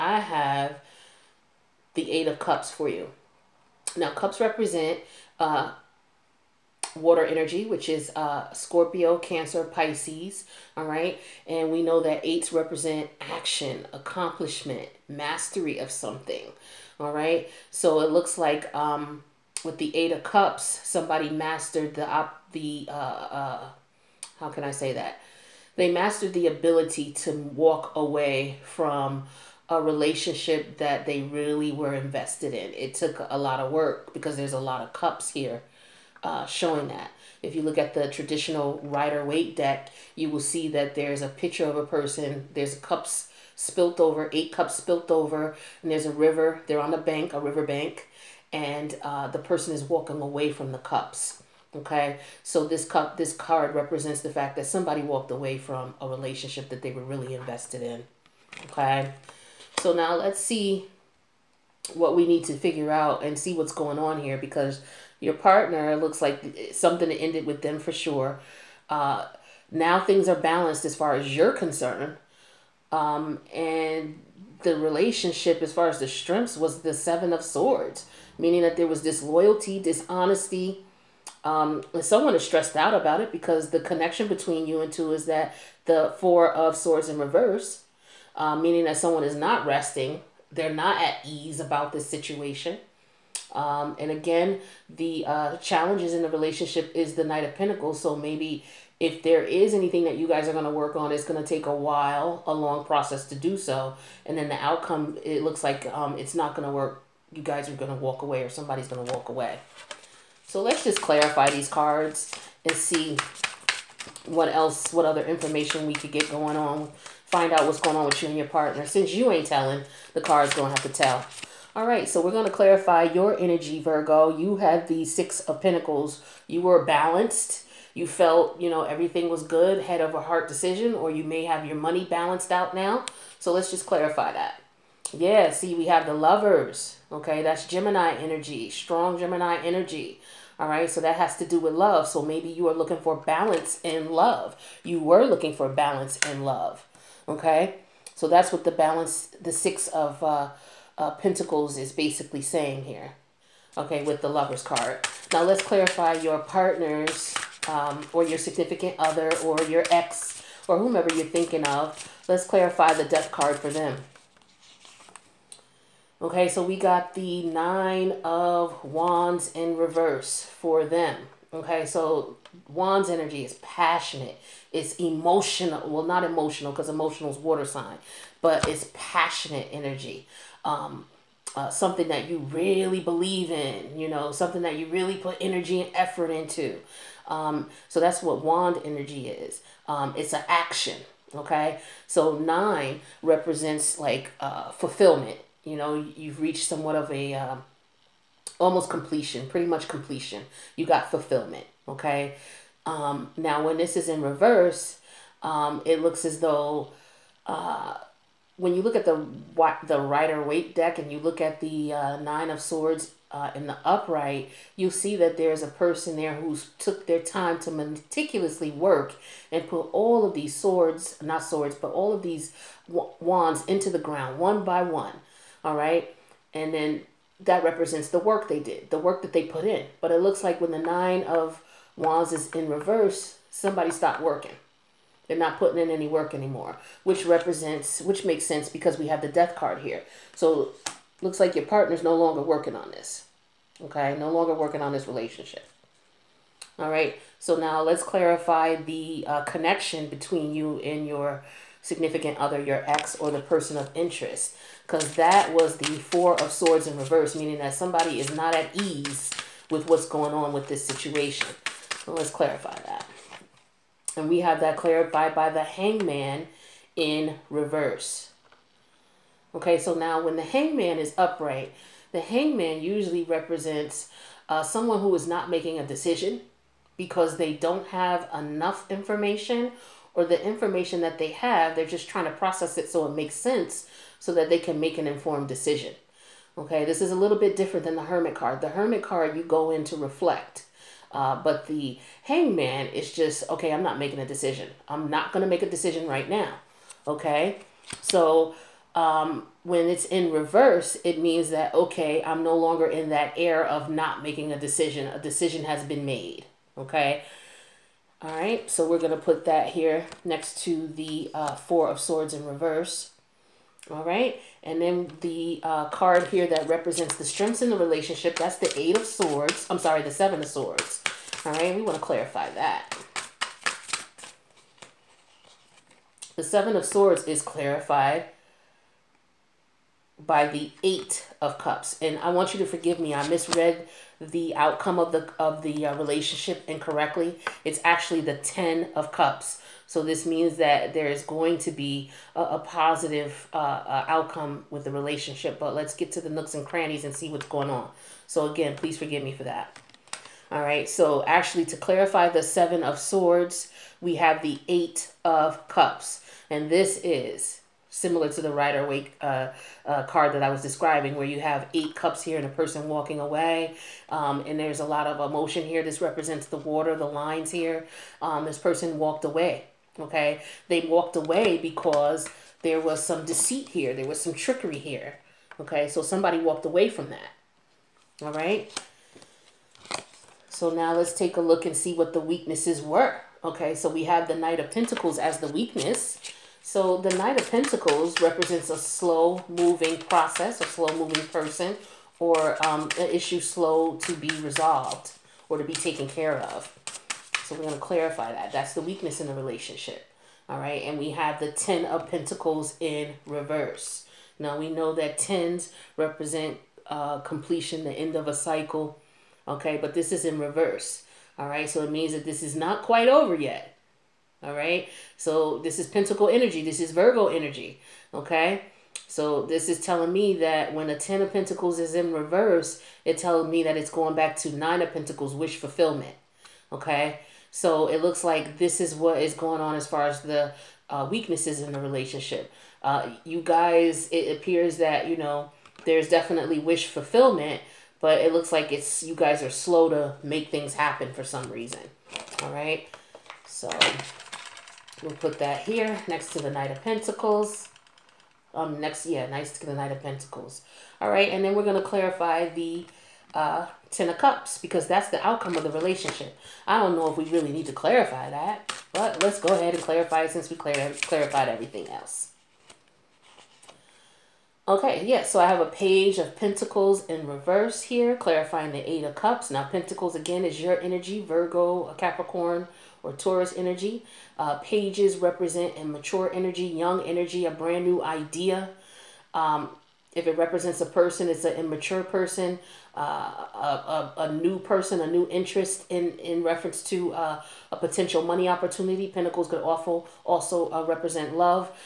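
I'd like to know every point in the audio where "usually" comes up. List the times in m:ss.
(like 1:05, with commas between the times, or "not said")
4:32.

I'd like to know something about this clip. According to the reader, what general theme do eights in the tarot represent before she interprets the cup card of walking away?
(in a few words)
action, accomplishment, mastery.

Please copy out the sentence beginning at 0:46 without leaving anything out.
They're on a bank, a river bank, and uh, the person is walking away from the cups.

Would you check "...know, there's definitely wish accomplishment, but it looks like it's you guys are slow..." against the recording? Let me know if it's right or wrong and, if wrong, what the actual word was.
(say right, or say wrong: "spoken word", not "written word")
wrong: "fulfillment", not "accomplishment".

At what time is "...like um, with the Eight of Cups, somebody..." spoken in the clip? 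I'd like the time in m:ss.
0:18.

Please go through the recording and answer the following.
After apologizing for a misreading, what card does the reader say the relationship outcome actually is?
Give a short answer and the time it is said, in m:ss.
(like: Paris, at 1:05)
Ten of Cups, at 5:38.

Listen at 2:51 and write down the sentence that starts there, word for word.
Okay, so Wands energy is passionate.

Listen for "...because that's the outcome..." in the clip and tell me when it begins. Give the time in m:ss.
7:34.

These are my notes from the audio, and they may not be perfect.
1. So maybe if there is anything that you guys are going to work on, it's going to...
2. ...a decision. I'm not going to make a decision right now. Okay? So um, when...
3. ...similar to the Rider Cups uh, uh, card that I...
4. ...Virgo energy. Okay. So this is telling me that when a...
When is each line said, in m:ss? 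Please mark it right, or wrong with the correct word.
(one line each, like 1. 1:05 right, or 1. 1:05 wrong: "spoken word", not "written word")
1. 1:38 right
2. 4:54 right
3. 5:57 wrong: "Waite", not "Cups"
4. 6:56 right.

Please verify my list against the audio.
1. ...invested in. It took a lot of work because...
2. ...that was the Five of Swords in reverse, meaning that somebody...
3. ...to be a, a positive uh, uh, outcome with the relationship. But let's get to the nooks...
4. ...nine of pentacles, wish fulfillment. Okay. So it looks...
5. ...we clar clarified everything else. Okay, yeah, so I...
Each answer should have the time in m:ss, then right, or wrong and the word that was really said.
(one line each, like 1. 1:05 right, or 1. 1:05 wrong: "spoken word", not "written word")
1. 0:31 right
2. 4:15 wrong: "Four", not "Five"
3. 5:41 right
4. 7:04 right
5. 7:40 right.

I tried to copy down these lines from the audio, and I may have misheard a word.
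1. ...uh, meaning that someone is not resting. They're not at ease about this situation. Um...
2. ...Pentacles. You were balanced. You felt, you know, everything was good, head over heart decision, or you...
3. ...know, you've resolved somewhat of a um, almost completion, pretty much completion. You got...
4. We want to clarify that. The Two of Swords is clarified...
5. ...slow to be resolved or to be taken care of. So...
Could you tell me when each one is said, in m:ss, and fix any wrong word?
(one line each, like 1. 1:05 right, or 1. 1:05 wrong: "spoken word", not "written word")
1. 1:28 right
2. 2:05 right
3. 3:15 wrong: "reached", not "resolved"
4. 5:21 wrong: "Seven", not "Two"
5. 6:33 right.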